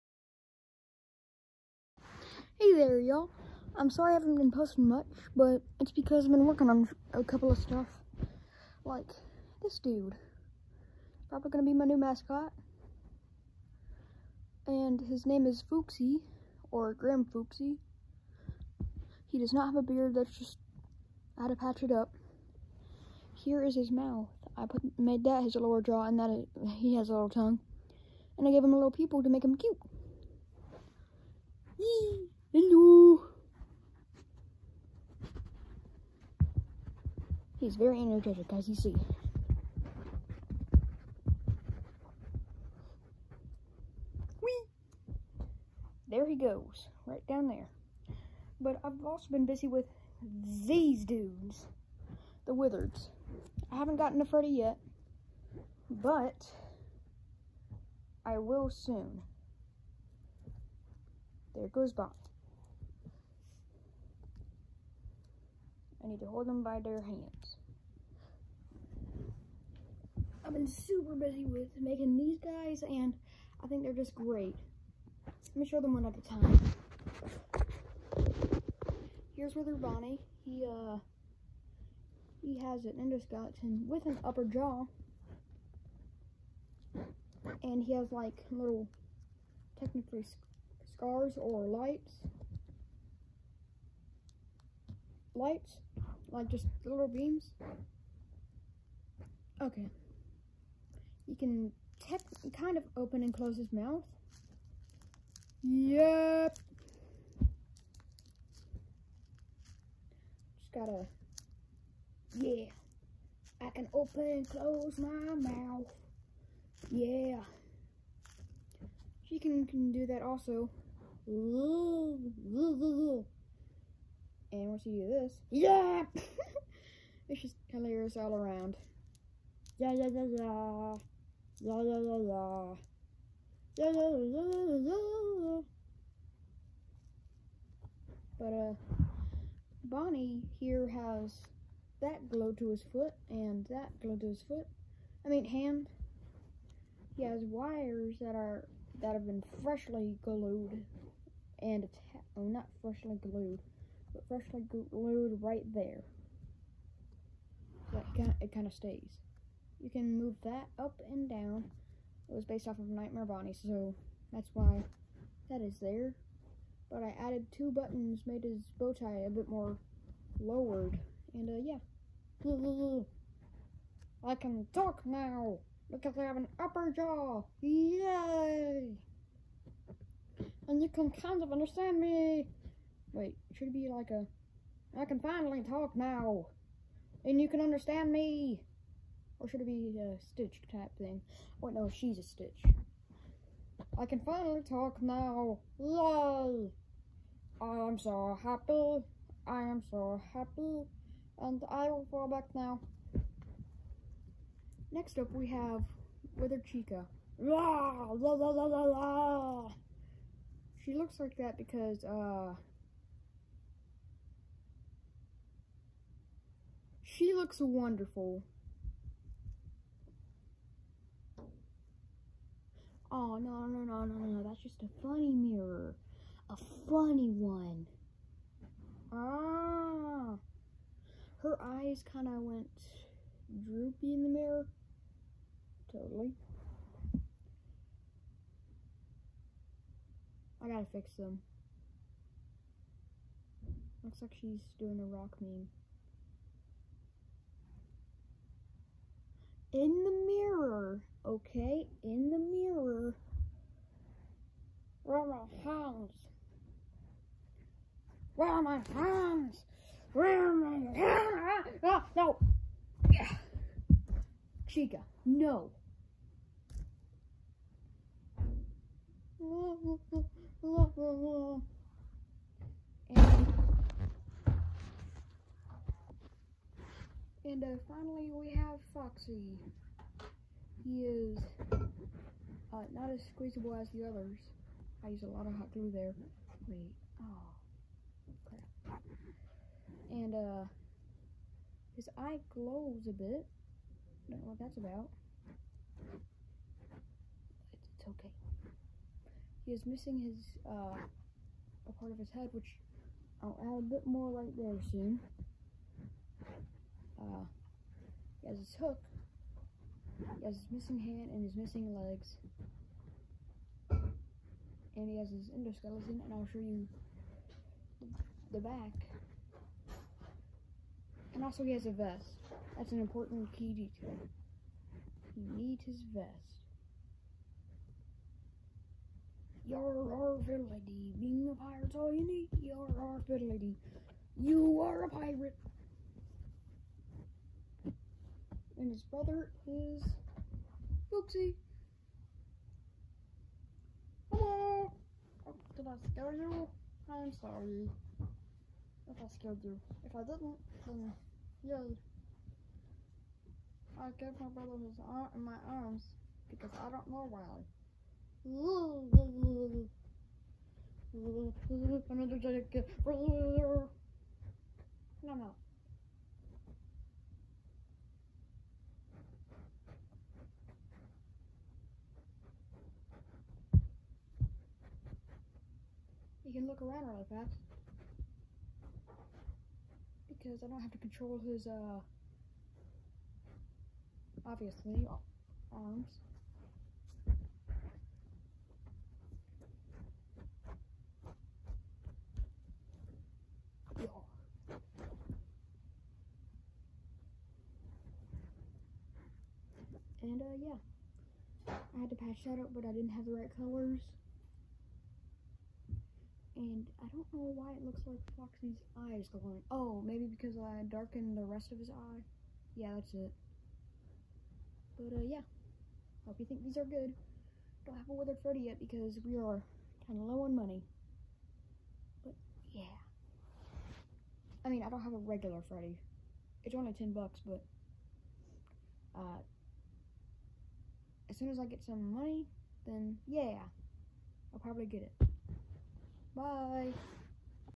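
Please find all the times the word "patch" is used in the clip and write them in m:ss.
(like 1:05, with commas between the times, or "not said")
0:21, 6:42.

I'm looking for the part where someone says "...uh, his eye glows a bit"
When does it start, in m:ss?
4:50.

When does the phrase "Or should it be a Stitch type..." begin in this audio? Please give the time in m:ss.
3:09.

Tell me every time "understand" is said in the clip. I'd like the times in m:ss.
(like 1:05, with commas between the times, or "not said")
3:01, 3:07.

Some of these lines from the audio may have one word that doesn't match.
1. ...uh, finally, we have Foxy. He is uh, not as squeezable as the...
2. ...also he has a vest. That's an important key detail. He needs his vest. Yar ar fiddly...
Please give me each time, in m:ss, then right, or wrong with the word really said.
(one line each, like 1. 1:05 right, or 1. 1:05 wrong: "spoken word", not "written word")
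1. 4:37 right
2. 5:21 right.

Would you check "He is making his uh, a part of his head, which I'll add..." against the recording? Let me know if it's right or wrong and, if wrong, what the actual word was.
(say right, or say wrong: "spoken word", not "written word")
wrong: "missing", not "making".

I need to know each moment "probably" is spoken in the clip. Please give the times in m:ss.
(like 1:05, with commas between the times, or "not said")
0:11, 7:14.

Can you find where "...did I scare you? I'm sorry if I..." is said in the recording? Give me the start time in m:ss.
5:45.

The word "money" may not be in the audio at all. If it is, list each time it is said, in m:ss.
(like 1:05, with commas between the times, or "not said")
7:00, 7:12.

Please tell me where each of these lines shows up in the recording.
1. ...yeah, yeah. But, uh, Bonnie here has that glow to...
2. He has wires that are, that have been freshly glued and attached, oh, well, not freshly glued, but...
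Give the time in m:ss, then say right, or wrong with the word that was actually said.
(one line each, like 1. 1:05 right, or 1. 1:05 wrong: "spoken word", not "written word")
1. 2:14 right
2. 2:27 right.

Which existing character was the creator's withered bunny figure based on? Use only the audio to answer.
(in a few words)
Nightmare Bonnie.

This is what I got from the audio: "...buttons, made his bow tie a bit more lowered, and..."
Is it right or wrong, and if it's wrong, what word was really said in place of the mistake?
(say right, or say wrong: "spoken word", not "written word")
right.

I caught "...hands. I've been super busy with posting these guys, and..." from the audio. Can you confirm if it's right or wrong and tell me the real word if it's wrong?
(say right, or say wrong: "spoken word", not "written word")
wrong: "making", not "posting".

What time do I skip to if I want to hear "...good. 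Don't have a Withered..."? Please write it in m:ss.
6:56.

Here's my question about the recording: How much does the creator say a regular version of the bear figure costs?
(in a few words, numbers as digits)
$10.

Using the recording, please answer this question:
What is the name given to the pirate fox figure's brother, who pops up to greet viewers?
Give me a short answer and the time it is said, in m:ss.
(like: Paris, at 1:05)
Booksy, at 5:41.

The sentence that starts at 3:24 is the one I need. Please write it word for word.
Next up we have Wither Chica.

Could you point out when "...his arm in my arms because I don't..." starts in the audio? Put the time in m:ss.
5:54.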